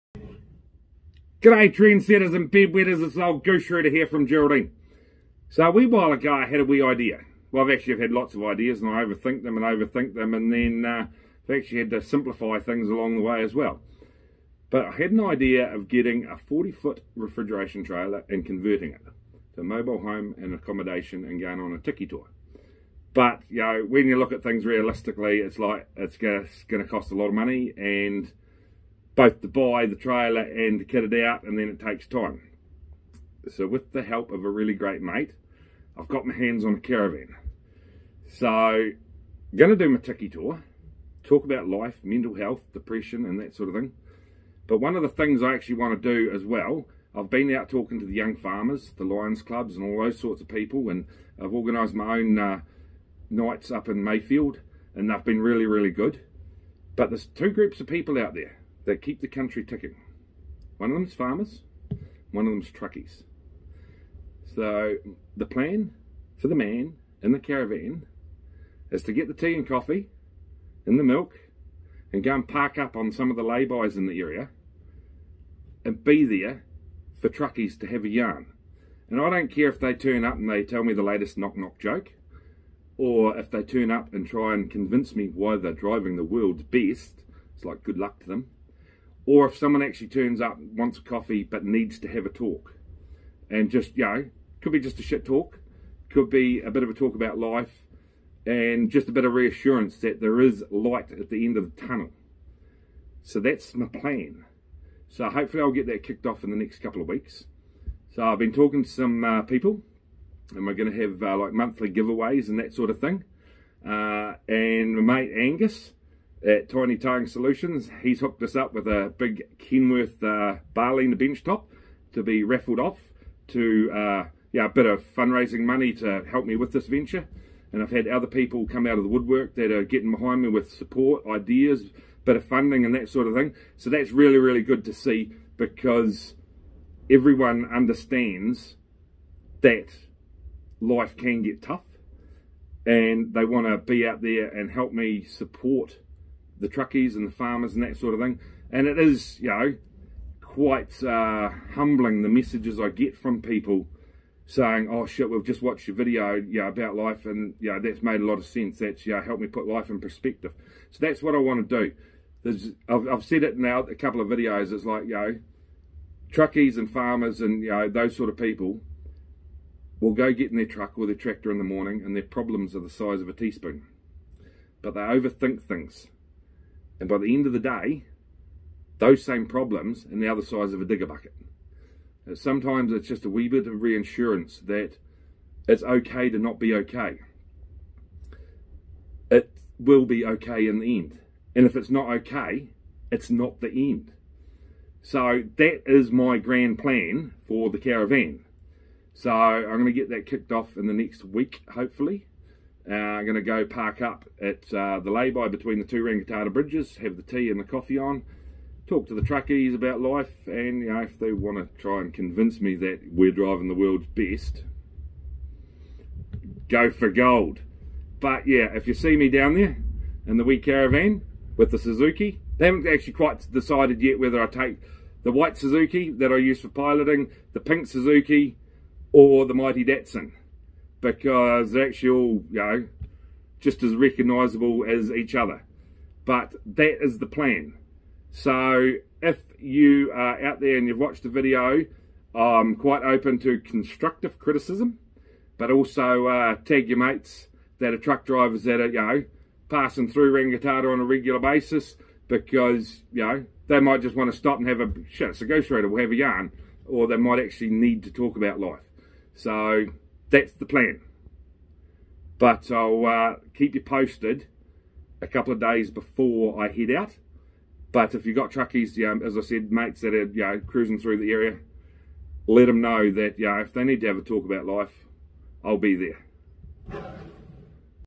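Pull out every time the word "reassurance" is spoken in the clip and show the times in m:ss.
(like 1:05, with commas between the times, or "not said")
1:39, 3:03.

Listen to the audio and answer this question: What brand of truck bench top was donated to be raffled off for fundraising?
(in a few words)
Kenworth.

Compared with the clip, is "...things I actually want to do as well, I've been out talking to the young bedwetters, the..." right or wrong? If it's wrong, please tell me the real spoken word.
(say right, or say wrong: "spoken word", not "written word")
wrong: "farmers", not "bedwetters".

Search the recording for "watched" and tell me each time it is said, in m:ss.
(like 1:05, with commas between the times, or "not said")
2:35, 4:00.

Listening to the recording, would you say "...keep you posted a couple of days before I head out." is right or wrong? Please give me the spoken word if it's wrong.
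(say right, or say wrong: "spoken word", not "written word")
right.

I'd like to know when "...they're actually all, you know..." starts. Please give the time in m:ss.
3:51.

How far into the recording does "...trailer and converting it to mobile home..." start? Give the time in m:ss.
0:17.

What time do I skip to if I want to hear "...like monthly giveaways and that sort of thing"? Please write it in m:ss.
1:51.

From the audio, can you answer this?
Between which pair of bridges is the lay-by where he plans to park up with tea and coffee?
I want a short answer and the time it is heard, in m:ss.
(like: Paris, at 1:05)
Rangitata bridges, at 3:26.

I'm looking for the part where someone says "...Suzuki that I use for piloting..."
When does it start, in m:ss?
3:45.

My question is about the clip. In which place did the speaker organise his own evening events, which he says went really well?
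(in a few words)
Mayfield.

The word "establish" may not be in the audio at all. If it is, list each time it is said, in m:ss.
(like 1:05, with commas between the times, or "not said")
not said.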